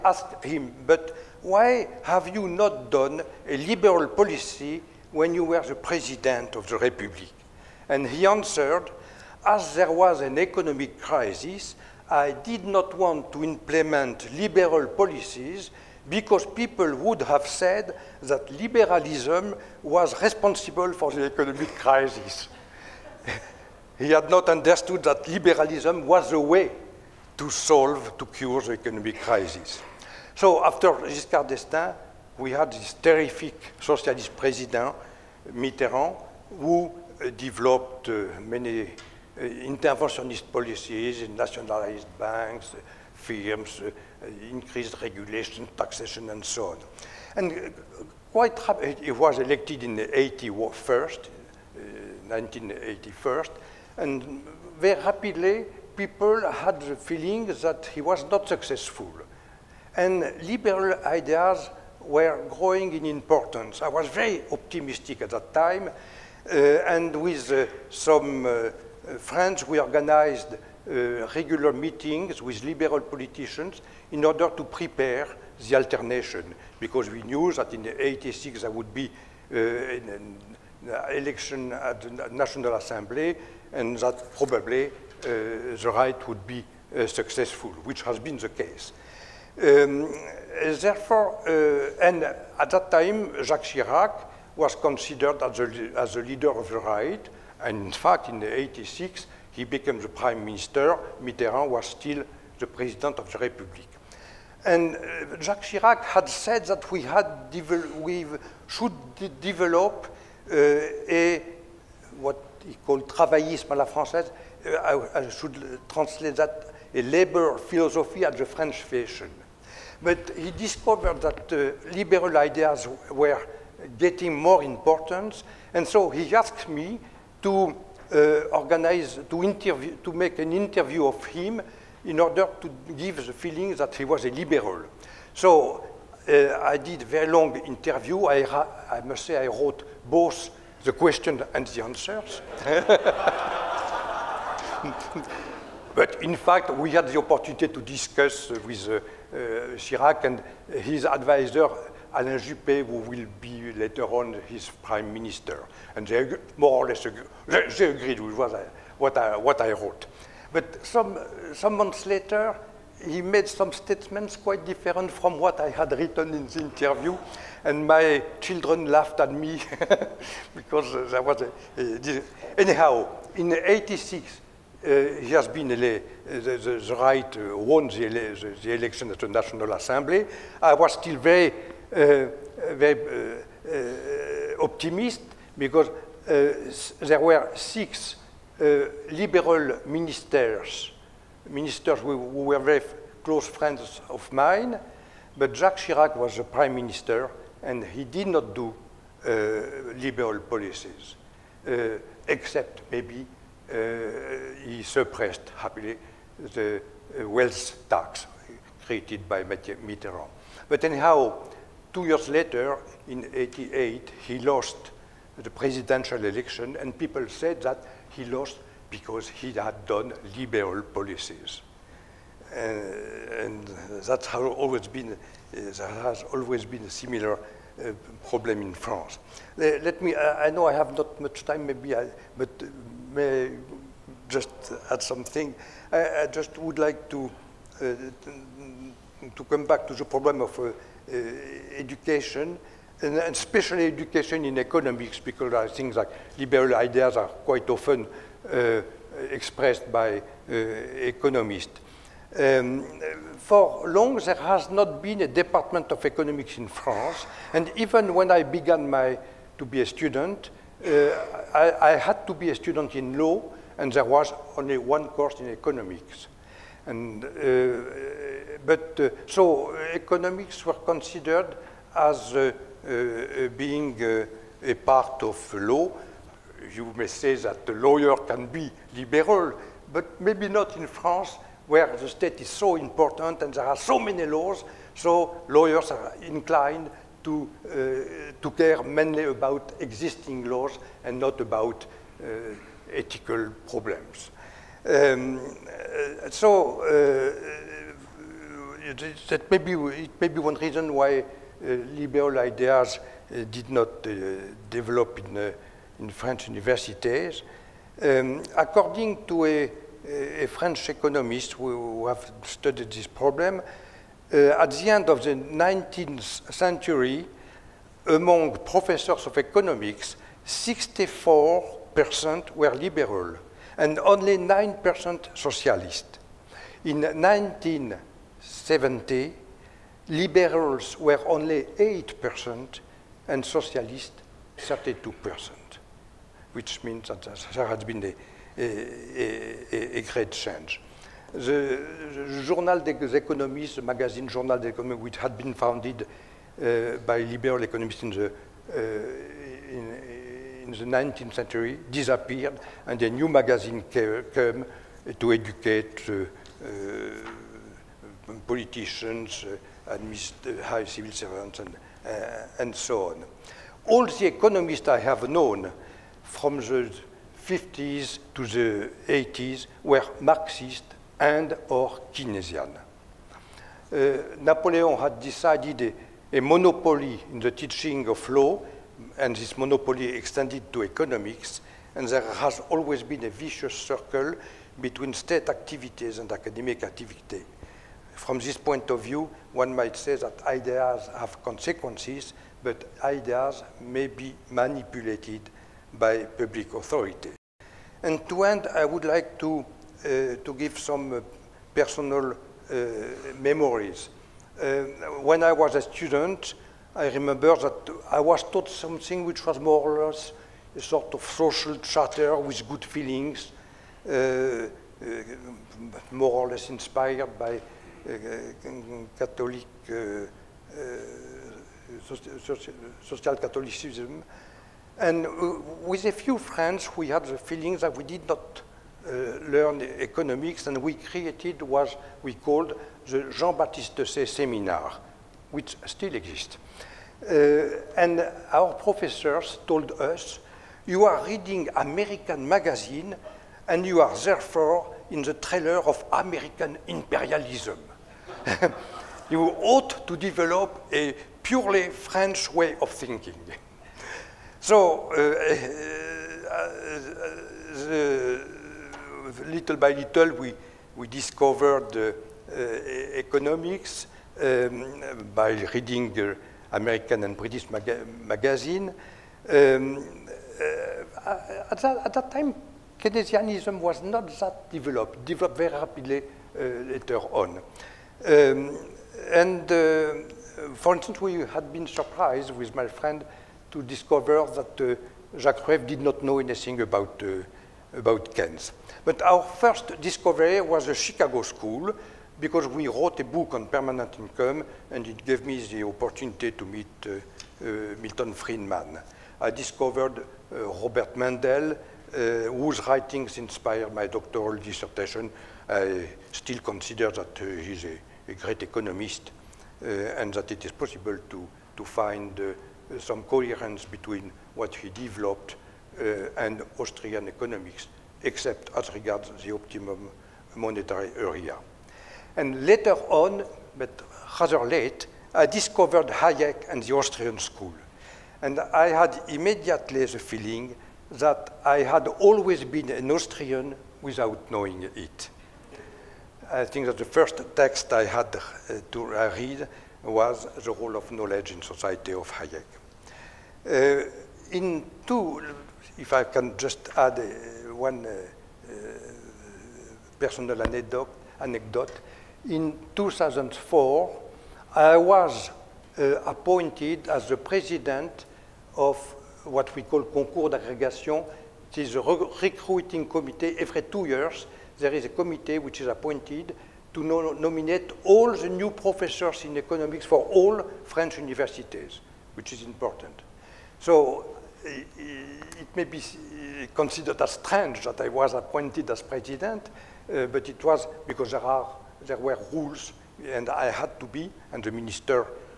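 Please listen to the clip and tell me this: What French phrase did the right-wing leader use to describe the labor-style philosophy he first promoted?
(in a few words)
travaillisme à la française.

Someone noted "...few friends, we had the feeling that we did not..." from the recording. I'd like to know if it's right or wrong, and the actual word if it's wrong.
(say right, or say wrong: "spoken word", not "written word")
right.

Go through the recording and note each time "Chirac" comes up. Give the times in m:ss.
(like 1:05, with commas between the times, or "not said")
1:33, 1:45, 2:29, 3:15.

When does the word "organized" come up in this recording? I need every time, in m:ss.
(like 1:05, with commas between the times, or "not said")
1:09, 2:08.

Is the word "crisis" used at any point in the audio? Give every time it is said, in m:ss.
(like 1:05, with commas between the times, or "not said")
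0:10, 0:21, 0:29.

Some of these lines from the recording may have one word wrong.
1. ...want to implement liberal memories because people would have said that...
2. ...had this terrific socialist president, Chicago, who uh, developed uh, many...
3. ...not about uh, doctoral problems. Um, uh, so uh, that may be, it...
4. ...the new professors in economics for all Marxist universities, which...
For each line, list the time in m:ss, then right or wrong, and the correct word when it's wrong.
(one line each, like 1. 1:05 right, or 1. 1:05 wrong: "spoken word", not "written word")
1. 0:12 wrong: "policies", not "memories"
2. 0:32 wrong: "Mitterrand", not "Chicago"
3. 4:51 wrong: "ethical", not "doctoral"
4. 9:28 wrong: "French", not "Marxist".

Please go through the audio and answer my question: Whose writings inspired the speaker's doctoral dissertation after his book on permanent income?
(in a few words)
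Robert Mundell.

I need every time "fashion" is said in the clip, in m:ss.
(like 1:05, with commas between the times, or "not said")
1:58.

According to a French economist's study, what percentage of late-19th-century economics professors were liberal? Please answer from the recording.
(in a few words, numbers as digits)
64%.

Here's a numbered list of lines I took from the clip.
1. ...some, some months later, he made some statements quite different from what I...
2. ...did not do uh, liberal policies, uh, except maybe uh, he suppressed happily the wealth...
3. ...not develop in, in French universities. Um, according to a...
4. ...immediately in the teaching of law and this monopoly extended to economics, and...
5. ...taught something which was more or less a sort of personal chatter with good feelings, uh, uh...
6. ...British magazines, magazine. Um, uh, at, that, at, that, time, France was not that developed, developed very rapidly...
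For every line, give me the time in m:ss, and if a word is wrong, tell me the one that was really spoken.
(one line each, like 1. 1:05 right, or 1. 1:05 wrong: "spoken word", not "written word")
1. 2:40 right
2. 3:18 right
3. 5:03 right
4. 6:16 wrong: "monopoly", not "immediately"
5. 6:48 wrong: "social", not "personal"
6. 7:47 wrong: "Keynesianism", not "France".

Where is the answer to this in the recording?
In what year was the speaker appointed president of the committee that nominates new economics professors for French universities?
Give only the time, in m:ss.
9:12.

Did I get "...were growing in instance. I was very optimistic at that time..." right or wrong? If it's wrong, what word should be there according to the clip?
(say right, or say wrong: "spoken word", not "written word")
wrong: "importance", not "instance".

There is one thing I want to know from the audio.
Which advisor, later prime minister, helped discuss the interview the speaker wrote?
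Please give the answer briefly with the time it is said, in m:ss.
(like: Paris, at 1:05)
Alain Juppé, at 2:32.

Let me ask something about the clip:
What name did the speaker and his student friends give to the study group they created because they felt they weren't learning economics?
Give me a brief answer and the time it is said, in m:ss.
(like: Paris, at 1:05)
Jean-Baptiste Say Seminar, at 7:13.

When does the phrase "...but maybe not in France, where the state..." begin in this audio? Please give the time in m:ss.
4:39.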